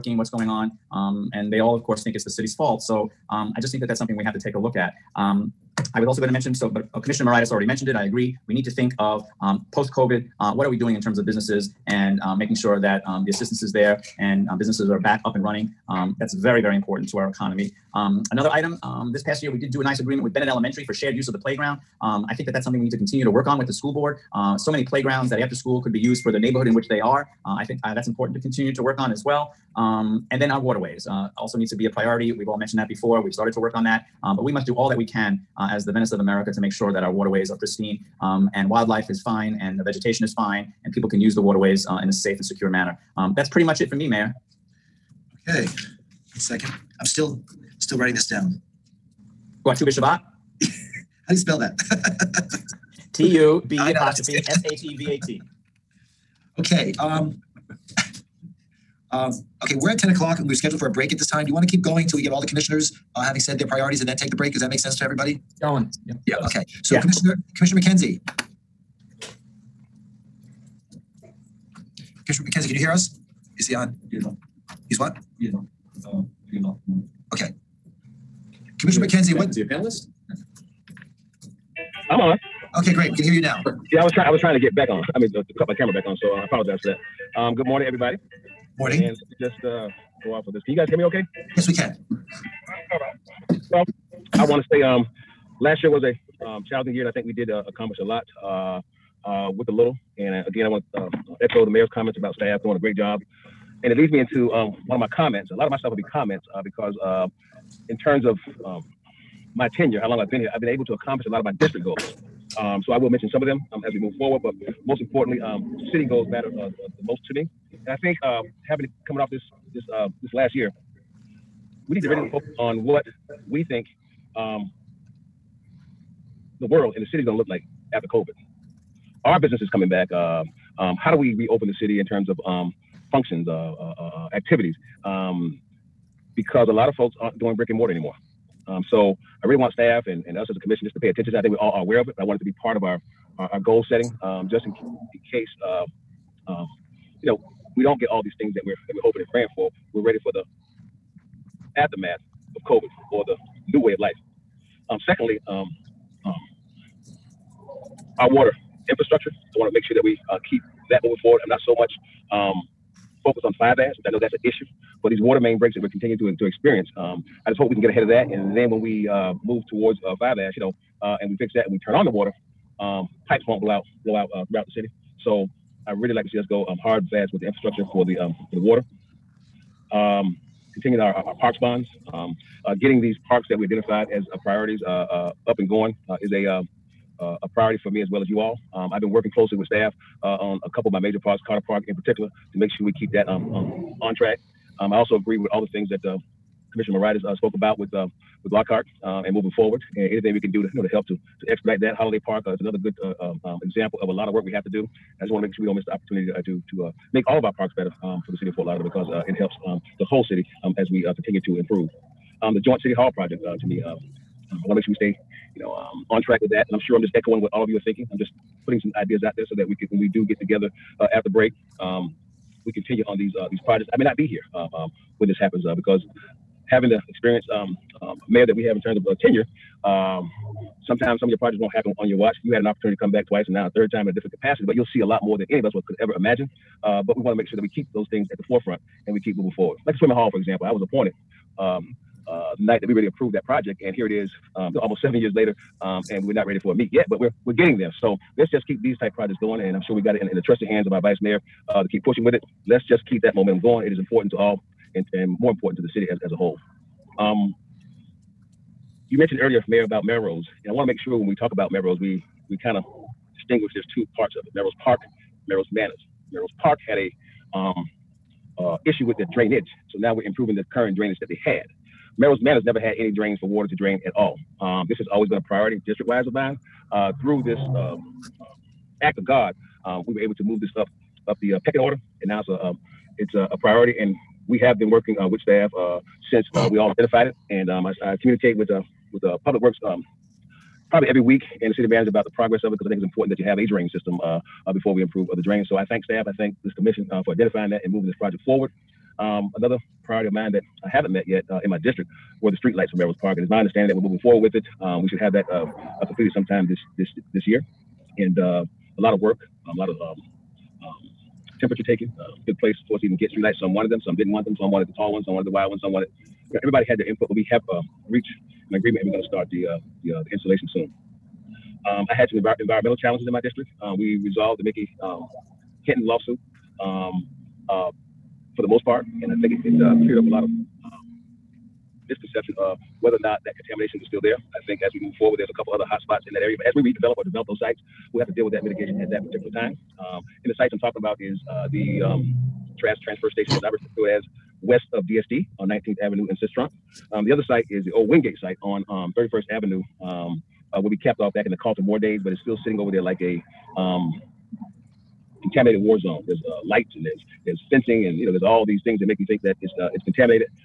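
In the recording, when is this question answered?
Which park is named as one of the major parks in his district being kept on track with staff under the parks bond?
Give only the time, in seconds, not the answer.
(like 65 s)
191 s.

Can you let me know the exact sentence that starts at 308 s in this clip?
And uh, a lot of work, um, a lot of um, um, temperature taken.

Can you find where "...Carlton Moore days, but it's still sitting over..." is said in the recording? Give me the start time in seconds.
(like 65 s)
351 s.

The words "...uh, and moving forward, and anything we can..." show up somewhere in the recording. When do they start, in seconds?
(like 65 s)
199 s.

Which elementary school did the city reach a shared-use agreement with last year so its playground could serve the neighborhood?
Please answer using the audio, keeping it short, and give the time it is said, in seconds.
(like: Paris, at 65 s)
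Bennett Elementary, at 20 s.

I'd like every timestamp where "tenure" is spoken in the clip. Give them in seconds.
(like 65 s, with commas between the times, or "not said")
109 s, 229 s.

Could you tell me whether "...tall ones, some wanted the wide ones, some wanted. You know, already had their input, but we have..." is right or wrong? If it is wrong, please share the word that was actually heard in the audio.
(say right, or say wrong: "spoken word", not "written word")
wrong: "everybody", not "already".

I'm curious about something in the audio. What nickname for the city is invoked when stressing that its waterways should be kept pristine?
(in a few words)
the Venice of America.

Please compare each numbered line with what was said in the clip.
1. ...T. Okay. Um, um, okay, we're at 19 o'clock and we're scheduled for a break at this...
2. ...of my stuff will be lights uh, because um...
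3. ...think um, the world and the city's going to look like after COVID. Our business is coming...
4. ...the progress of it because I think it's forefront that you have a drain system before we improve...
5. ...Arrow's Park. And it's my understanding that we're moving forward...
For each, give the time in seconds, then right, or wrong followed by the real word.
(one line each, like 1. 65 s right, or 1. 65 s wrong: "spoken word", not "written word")
1. 55 s wrong: "10", not "19"
2. 105 s wrong: "comments", not "lights"
3. 123 s right
4. 292 s wrong: "important", not "forefront"
5. 302 s right.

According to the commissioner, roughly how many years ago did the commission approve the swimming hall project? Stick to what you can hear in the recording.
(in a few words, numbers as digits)
7.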